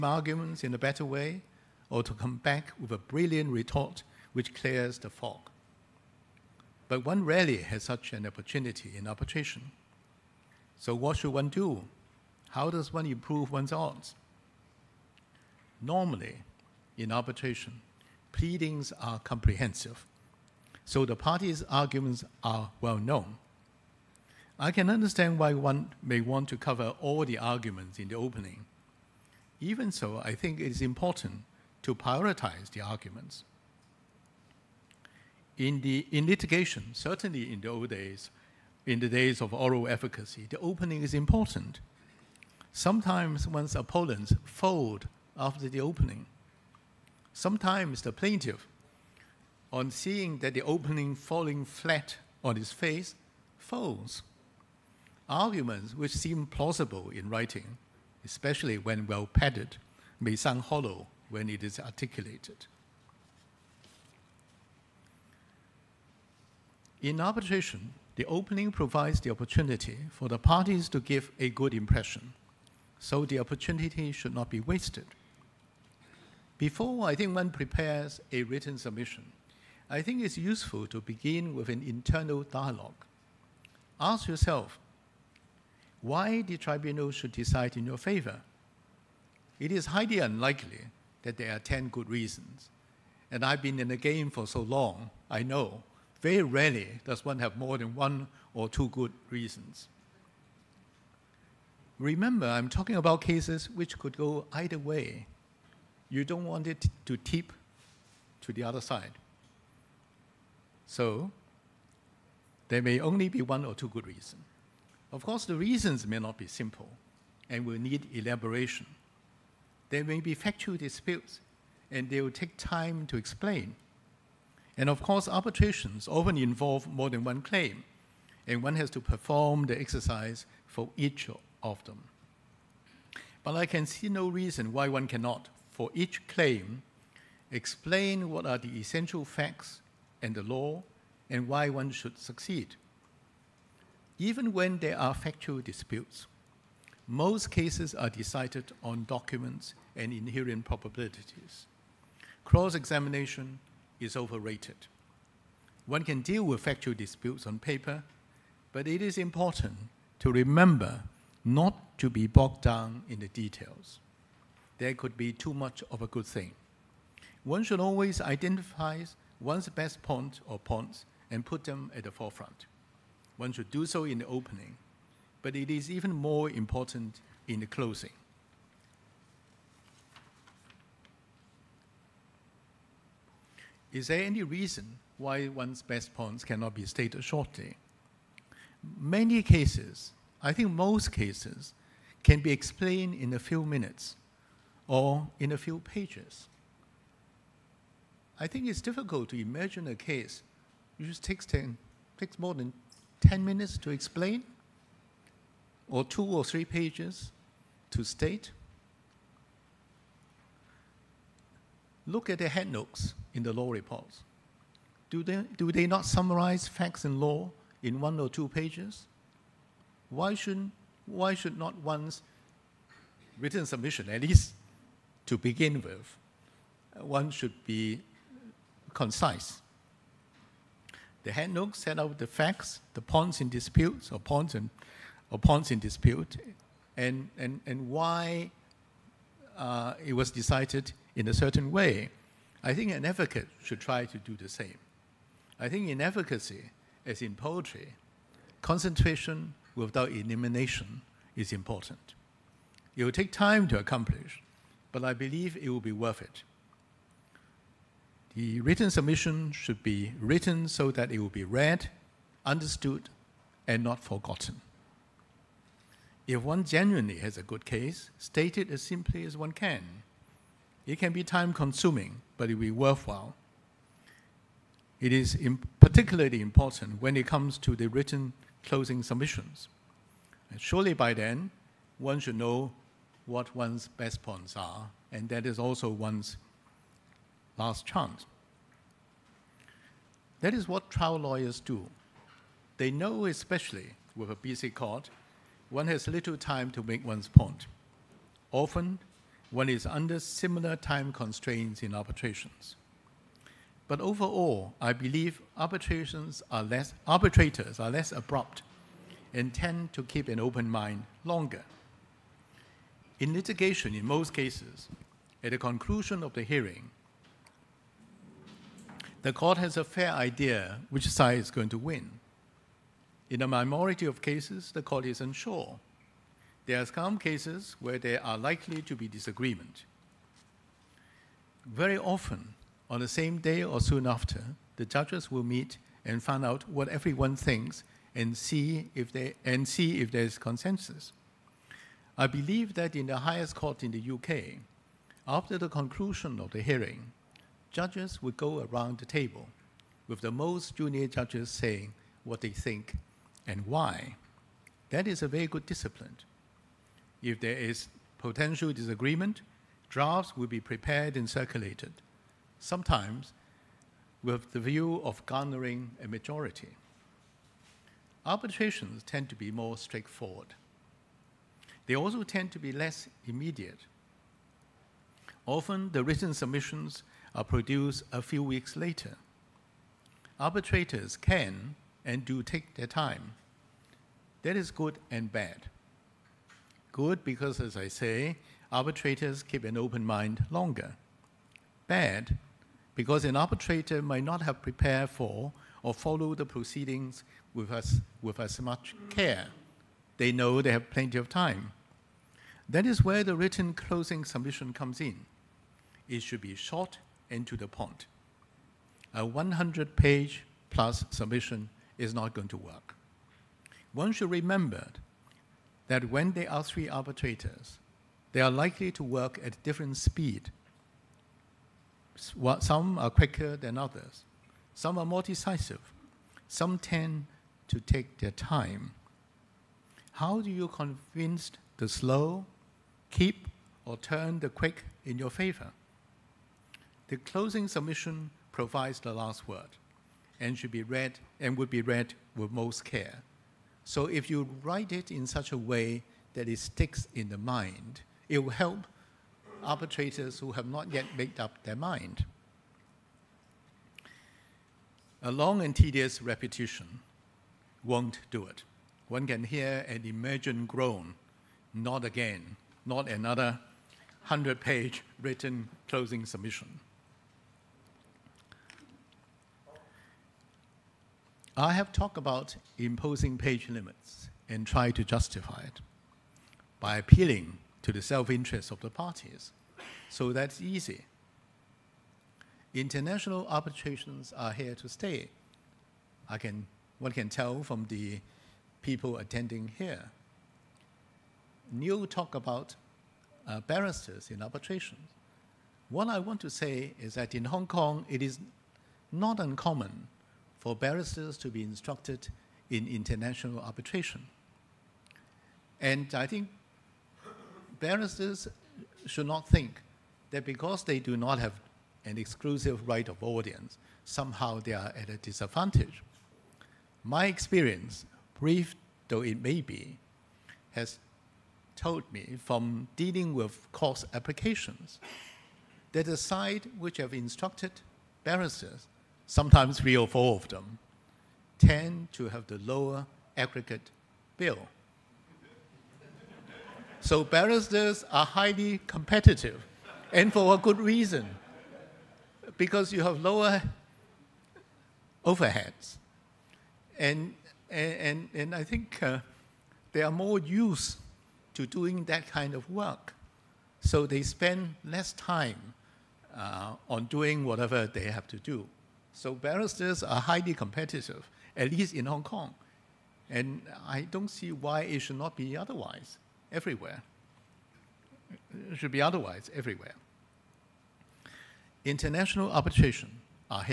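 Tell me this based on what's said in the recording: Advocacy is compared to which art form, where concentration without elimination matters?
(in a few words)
Poetry.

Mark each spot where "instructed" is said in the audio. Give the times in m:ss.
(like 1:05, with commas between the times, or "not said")
8:21, 8:47.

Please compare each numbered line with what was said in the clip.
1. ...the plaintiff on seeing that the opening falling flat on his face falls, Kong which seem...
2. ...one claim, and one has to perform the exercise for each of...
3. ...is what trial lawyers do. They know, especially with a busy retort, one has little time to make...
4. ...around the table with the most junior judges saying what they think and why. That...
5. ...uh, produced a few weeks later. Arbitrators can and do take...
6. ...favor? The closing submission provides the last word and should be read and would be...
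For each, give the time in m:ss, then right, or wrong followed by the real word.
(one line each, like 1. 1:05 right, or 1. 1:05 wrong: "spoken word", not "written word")
1. 0:48 wrong: "Arguments", not "Kong"
2. 2:07 right
3. 4:50 wrong: "court", not "retort"
4. 5:48 right
5. 6:17 right
6. 7:15 right.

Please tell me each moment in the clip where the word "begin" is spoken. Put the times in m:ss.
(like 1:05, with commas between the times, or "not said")
1:21, 3:45.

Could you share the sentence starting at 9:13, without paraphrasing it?
So they spend less time uh, on doing whatever they have to do.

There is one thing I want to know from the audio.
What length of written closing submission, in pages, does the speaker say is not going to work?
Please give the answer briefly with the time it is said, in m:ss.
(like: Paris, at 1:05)
100 pages plus, at 6:49.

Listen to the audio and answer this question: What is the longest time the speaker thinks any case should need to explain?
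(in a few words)
10 minutes.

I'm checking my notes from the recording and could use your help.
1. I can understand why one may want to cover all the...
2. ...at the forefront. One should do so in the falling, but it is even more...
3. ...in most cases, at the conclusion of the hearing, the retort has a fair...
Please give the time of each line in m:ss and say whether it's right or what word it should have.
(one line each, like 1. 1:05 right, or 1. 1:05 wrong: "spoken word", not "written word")
1. 0:24 right
2. 2:51 wrong: "opening", not "falling"
3. 5:13 wrong: "court", not "retort".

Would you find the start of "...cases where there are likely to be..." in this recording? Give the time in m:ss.
5:27.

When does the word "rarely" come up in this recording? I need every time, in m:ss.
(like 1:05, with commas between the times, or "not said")
0:07, 1:36.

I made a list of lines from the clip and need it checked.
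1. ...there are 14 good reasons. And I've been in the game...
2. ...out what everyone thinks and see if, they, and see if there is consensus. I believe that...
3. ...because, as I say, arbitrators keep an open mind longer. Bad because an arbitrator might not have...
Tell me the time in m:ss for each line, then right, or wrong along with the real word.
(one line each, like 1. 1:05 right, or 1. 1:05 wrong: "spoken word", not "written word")
1. 1:31 wrong: "10", not "14"
2. 5:36 right
3. 6:27 right.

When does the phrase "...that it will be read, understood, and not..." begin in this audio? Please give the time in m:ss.
4:20.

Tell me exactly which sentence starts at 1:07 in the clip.
In arbitration, the opening provides the opportunity for the parties to give a good impression, so the opportunity should not be wasted.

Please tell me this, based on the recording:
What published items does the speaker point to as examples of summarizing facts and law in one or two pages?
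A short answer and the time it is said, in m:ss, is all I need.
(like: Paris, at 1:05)
Headnotes in the law reports, at 3:32.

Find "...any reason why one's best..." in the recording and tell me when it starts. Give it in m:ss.
3:04.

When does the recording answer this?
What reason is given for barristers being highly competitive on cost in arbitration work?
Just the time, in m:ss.
9:03.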